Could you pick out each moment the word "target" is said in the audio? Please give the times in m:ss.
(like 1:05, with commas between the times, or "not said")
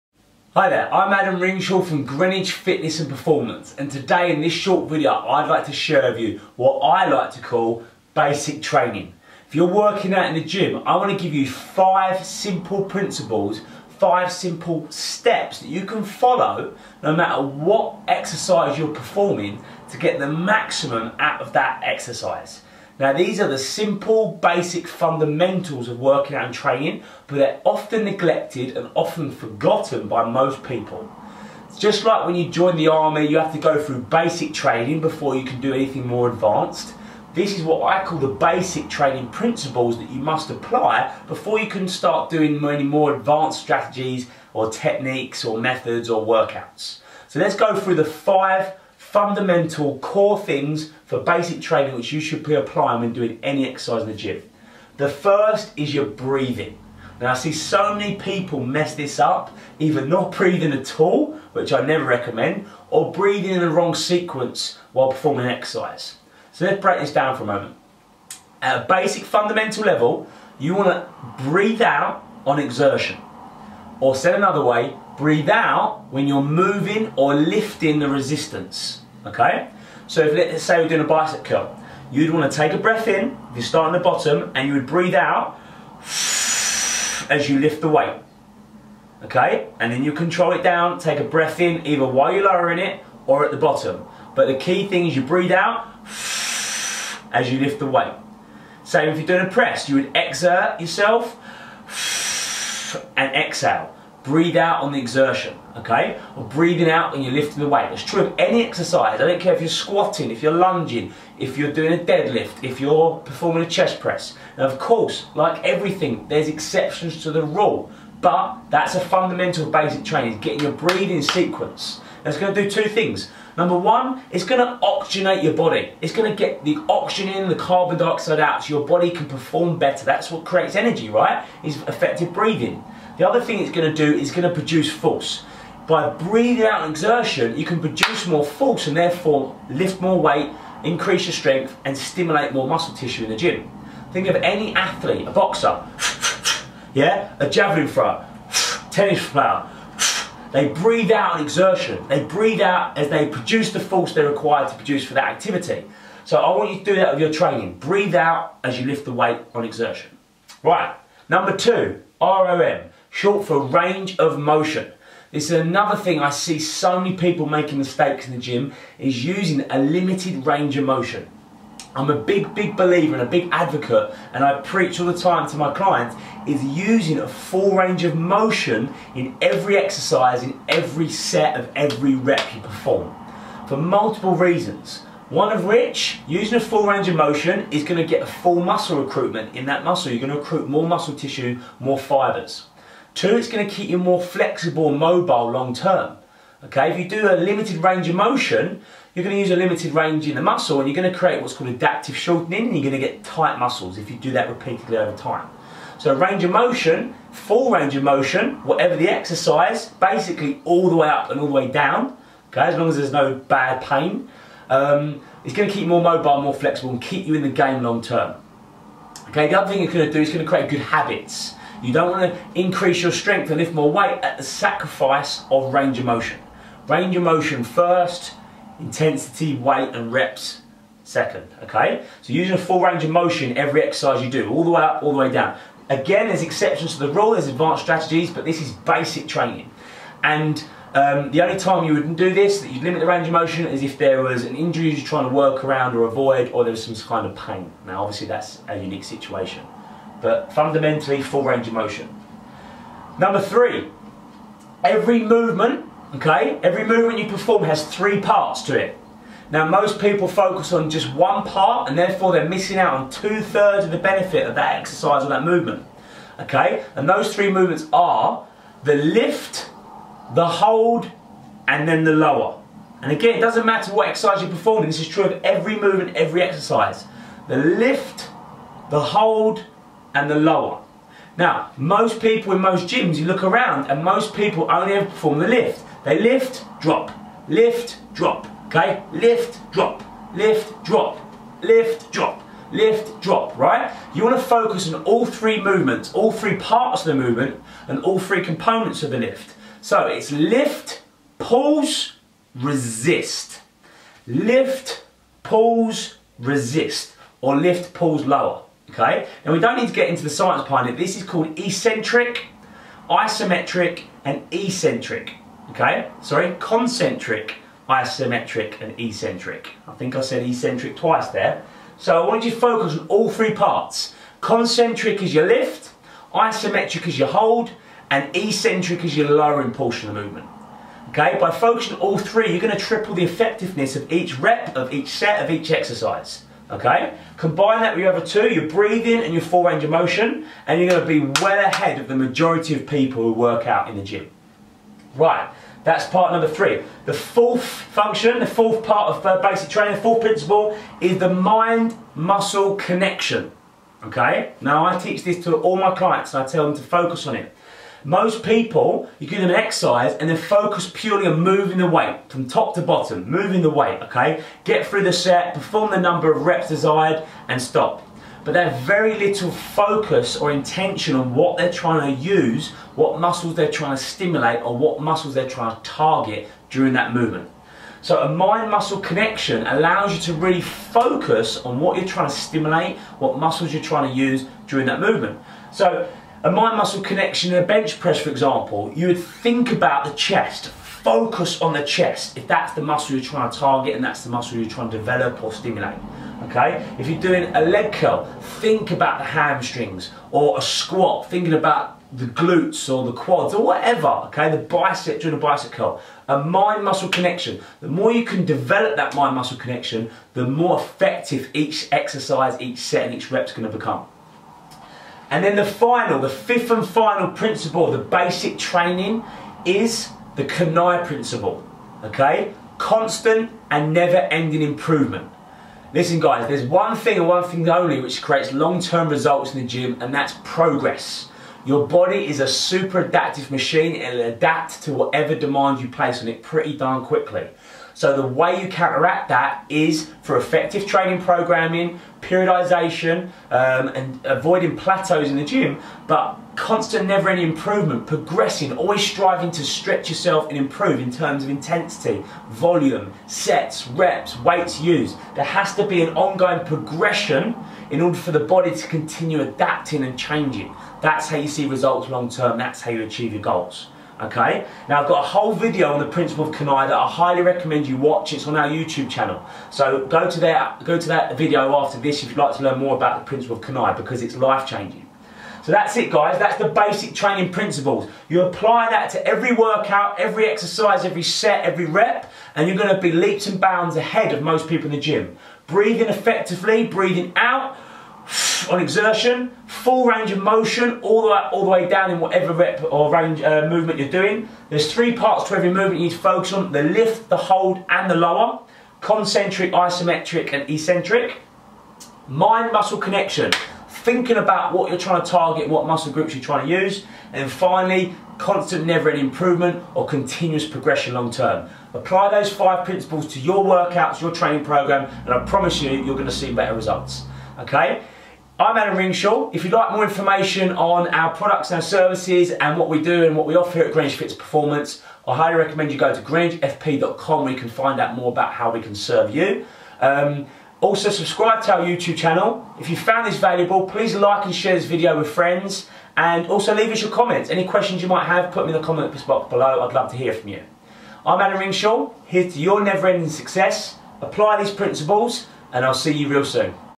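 6:15, 6:33, 8:25.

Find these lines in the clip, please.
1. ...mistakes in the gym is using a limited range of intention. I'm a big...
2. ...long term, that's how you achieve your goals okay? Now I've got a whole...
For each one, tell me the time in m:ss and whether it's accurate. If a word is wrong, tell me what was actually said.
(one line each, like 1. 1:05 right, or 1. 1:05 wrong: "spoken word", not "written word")
1. 2:47 wrong: "motion", not "intention"
2. 7:42 right.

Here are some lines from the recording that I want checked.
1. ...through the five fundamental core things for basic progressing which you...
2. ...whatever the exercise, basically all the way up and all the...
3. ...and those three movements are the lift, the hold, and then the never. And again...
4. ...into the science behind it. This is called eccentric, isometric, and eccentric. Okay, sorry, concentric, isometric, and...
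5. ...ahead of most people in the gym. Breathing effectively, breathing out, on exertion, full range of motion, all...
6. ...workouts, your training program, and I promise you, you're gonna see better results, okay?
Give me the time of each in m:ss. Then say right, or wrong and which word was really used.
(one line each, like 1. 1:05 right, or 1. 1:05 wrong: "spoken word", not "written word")
1. 0:47 wrong: "training", not "progressing"
2. 3:28 right
3. 4:26 wrong: "lower", not "never"
4. 5:10 right
5. 8:03 right
6. 8:33 right.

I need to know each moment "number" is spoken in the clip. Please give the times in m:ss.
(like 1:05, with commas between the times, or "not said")
2:03, 2:41, 4:13, 5:46, 6:05.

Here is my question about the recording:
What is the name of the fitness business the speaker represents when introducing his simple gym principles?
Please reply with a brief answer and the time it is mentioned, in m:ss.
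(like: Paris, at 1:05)
Greenwich Fitness and Performance, at 0:02.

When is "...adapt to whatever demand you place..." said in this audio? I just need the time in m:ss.
7:14.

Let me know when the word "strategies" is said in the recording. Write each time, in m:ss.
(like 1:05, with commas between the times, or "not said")
0:43, 3:57.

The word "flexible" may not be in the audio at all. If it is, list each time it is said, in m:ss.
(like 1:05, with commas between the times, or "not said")
3:14, 3:36.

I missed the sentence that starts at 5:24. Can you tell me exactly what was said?
Concentric is your lift, isometric is your hold, and eccentric is your lowering portion of the movement.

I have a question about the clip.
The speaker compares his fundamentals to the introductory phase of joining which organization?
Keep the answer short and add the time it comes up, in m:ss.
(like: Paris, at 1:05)
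the army, at 0:32.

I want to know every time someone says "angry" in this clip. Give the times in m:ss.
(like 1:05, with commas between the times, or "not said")
not said.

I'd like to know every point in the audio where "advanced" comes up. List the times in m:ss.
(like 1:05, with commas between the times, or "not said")
0:36, 0:43, 3:57.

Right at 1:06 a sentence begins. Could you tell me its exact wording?
So let's break this down for a moment.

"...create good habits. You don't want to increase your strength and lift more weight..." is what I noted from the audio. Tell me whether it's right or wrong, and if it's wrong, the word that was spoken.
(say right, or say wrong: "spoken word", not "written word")
right.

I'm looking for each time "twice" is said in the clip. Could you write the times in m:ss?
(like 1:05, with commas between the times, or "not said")
5:20.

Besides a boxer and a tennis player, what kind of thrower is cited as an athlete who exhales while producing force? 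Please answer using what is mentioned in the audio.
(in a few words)
javelin thrower.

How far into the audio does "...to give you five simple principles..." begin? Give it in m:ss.
0:11.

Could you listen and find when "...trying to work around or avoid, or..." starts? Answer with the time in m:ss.
4:05.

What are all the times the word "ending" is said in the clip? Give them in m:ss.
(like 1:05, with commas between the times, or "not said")
7:04, 7:27, 8:28, 9:02.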